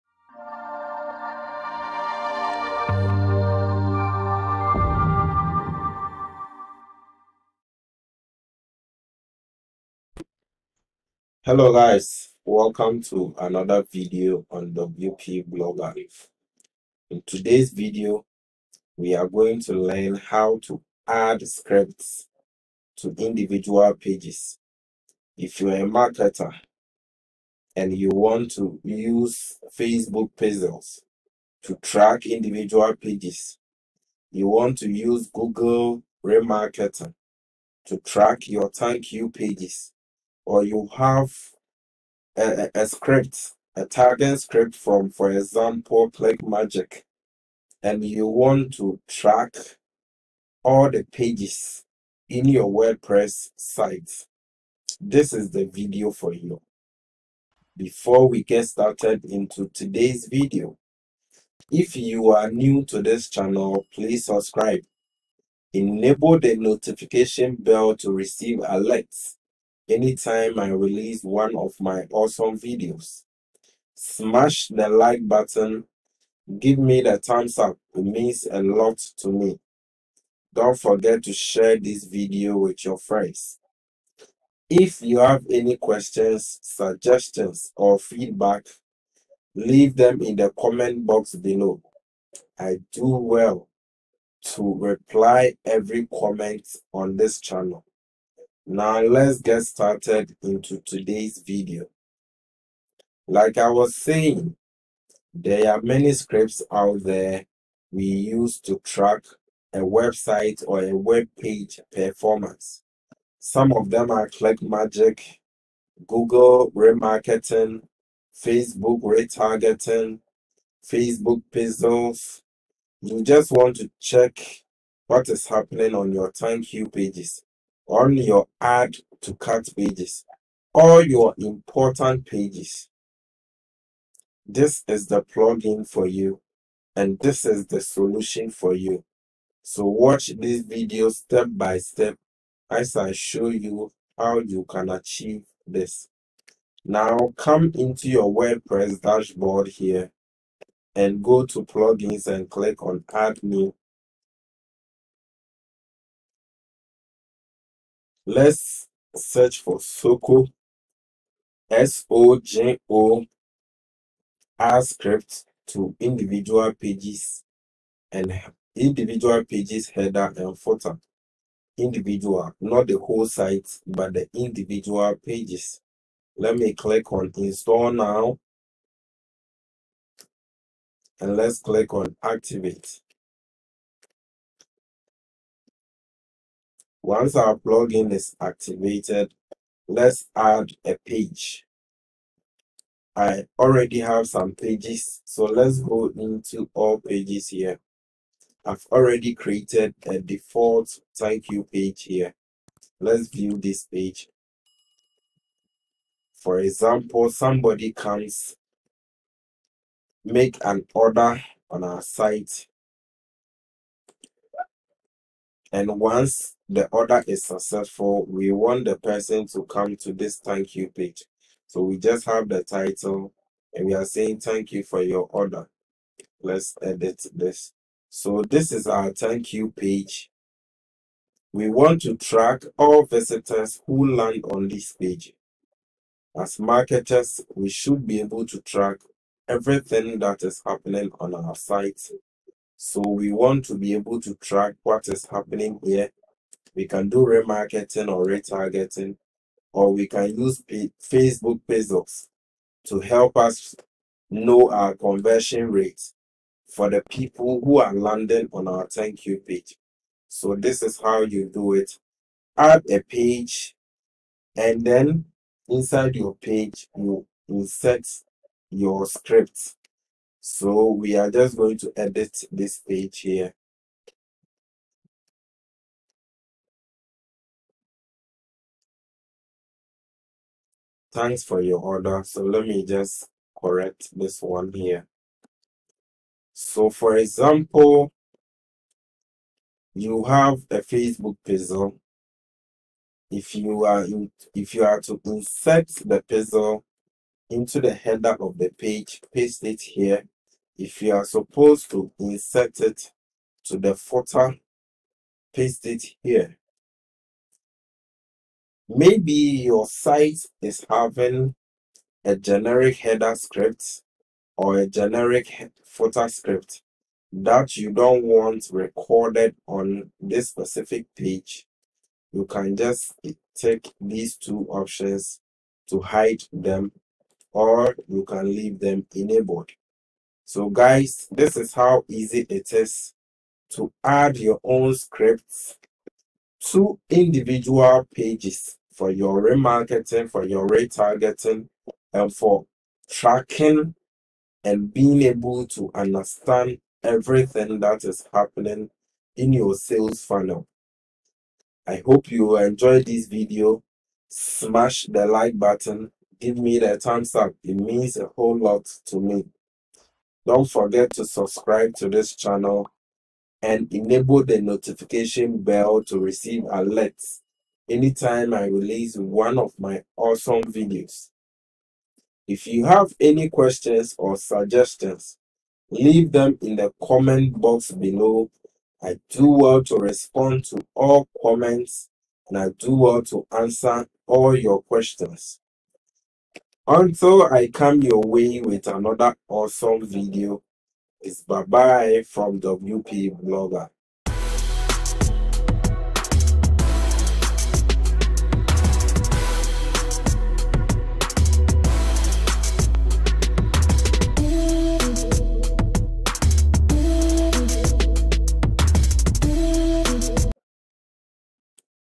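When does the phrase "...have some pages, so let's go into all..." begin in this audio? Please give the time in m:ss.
3:13.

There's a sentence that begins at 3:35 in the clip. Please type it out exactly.
And once the order is successful, we want the person to come to this thank you page.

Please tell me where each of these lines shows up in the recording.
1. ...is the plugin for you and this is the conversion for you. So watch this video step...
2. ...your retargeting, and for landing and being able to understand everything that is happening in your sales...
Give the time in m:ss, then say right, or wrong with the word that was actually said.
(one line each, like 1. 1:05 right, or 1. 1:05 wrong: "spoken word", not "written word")
1. 2:14 wrong: "solution", not "conversion"
2. 5:40 wrong: "tracking", not "landing".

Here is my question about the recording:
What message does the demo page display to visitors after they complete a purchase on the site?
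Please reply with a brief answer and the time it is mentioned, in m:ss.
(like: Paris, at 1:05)
thank you for your order, at 3:44.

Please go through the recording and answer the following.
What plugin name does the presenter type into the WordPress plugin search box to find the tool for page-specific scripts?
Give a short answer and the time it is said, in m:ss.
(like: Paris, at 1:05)
Sojo, at 2:39.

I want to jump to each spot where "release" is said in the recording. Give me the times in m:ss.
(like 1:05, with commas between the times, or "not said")
1:10, 6:08.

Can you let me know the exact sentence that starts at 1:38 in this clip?
Now let's get started into today's video.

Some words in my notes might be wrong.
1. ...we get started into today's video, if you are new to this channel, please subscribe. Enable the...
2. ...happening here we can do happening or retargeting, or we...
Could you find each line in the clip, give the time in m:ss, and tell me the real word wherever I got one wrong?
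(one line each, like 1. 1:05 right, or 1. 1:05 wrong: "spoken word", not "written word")
1. 0:58 right
2. 4:05 wrong: "remarketing", not "happening".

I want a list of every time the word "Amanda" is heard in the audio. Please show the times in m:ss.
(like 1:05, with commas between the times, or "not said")
not said.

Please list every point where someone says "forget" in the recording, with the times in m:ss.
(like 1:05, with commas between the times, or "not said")
1:20, 6:00.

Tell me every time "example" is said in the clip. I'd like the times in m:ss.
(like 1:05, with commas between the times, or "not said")
0:45, 3:26, 4:47.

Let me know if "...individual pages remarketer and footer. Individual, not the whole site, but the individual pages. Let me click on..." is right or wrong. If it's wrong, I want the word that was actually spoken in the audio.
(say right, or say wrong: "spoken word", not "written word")
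wrong: "header", not "remarketer".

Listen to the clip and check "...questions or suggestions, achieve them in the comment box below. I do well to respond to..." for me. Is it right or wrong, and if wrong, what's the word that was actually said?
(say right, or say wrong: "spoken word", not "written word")
wrong: "leave", not "achieve".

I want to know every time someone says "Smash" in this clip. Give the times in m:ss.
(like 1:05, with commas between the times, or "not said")
1:13, 5:54.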